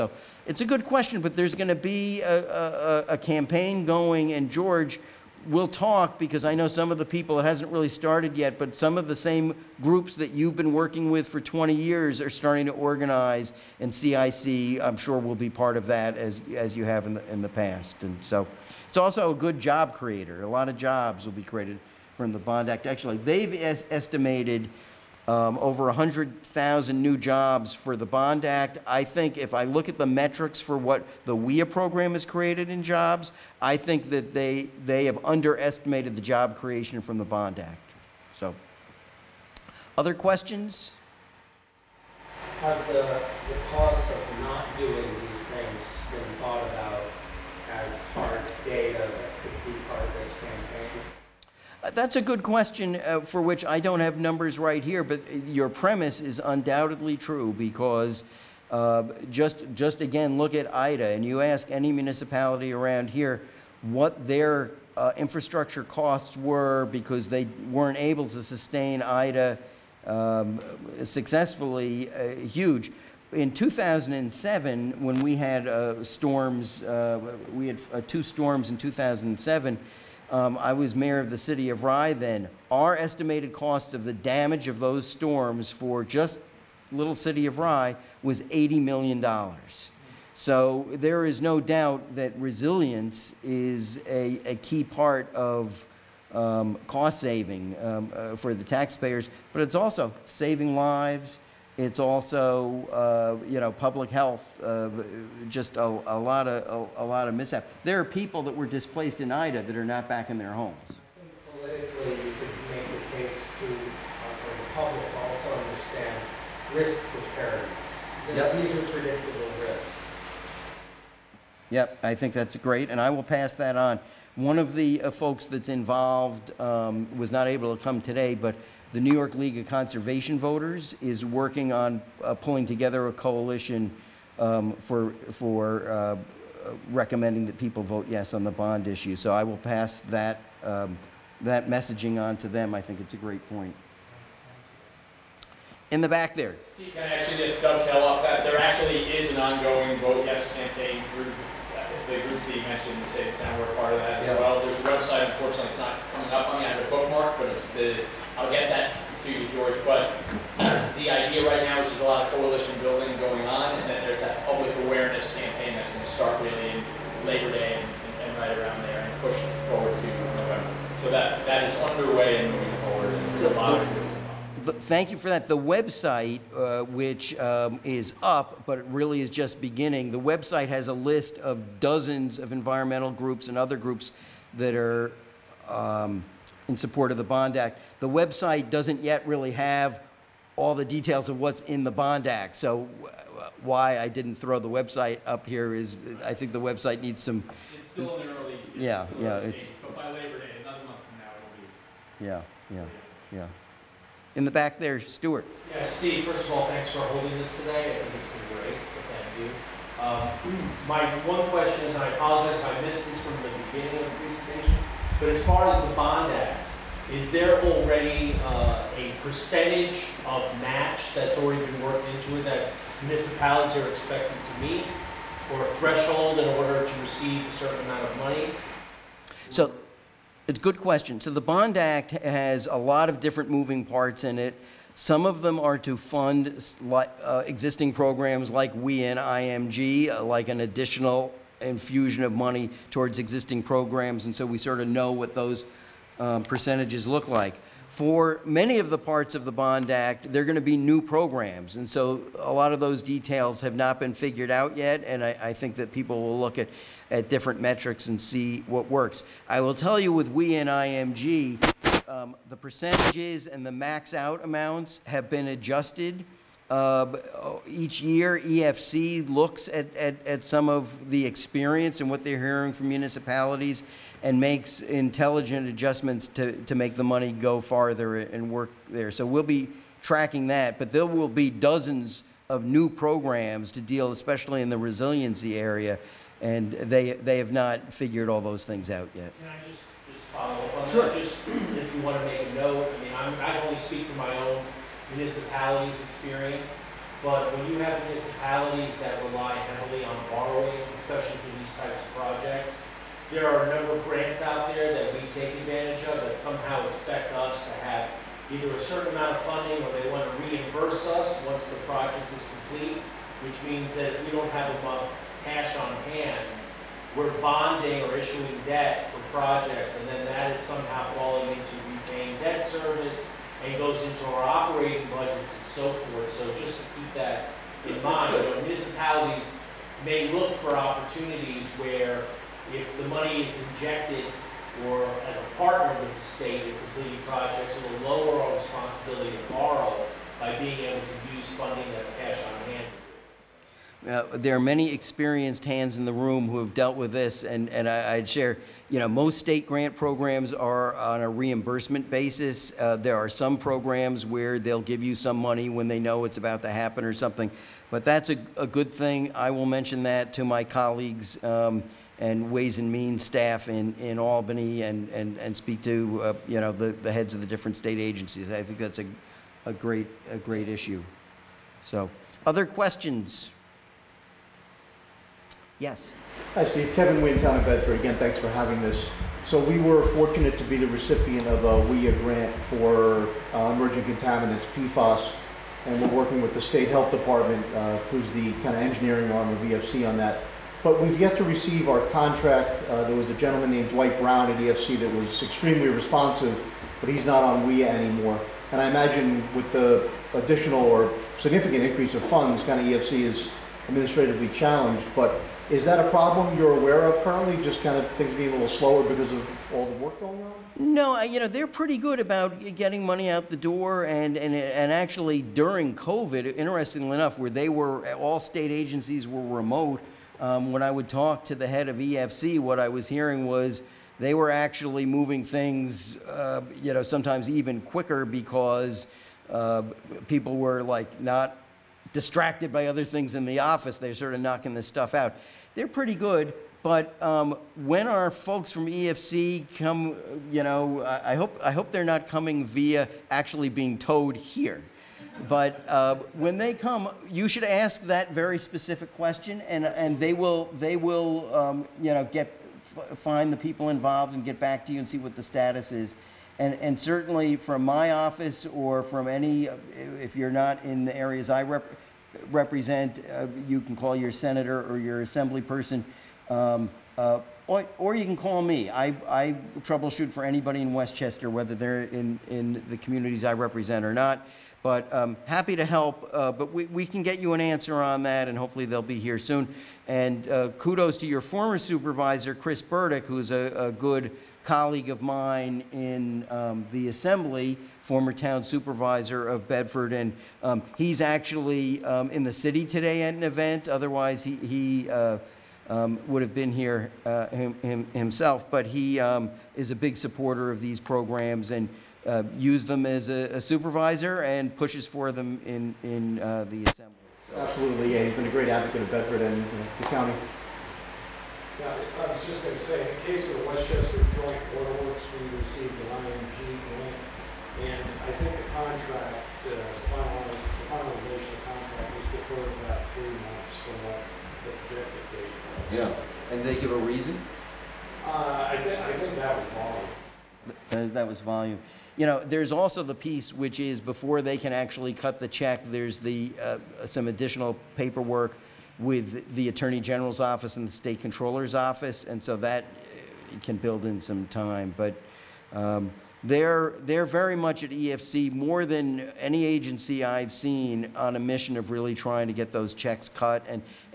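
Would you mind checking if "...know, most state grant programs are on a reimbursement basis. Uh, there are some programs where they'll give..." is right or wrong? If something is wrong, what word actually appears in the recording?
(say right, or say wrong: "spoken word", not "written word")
right.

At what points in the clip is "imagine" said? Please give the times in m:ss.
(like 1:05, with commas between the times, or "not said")
6:38.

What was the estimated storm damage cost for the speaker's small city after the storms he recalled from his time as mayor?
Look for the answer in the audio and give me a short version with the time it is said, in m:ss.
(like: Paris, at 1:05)
$80 million, at 1:28.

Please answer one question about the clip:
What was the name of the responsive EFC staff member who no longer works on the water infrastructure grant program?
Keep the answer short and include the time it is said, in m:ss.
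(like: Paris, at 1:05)
Dwight Brown, at 6:33.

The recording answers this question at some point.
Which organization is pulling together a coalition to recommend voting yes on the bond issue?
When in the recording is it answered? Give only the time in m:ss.
2:09.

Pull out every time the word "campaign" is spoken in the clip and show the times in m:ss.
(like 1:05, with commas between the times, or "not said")
0:03, 2:30, 2:45.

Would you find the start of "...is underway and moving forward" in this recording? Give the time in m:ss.
2:51.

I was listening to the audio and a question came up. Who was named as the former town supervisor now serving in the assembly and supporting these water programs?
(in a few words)
Chris Burdick.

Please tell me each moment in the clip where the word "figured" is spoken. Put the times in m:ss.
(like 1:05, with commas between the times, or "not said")
4:14, 4:47.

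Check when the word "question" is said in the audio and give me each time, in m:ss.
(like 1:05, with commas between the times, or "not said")
0:00, 0:40, 0:52, 3:31, 3:50, 6:12, 7:29.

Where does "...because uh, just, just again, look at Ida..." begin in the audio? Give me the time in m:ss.
0:57.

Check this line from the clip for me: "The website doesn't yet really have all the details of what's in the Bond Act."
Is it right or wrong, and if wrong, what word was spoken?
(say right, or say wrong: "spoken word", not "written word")
right.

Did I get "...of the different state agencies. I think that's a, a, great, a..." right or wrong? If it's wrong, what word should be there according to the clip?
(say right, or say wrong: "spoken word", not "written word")
right.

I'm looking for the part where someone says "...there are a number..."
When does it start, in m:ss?
5:03.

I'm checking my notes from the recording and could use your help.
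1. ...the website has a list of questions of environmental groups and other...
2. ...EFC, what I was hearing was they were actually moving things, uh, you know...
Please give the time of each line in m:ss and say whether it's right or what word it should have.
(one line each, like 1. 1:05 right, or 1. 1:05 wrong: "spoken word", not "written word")
1. 3:00 wrong: "dozens", not "questions"
2. 7:01 right.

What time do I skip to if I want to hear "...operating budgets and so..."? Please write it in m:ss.
5:24.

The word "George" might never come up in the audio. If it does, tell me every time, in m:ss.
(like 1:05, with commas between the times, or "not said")
0:04, 2:39.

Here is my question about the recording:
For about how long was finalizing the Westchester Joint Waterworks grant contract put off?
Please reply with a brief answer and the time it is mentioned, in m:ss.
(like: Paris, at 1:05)
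3 months, at 8:43.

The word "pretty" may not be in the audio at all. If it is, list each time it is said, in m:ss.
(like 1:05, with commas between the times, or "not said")
6:51, 7:15.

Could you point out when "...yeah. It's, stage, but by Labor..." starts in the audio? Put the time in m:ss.
3:19.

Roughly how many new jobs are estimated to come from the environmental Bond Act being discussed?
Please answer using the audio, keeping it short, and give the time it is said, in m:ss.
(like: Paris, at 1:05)
over 100,000, at 0:25.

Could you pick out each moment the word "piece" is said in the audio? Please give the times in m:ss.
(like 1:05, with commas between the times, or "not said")
8:53.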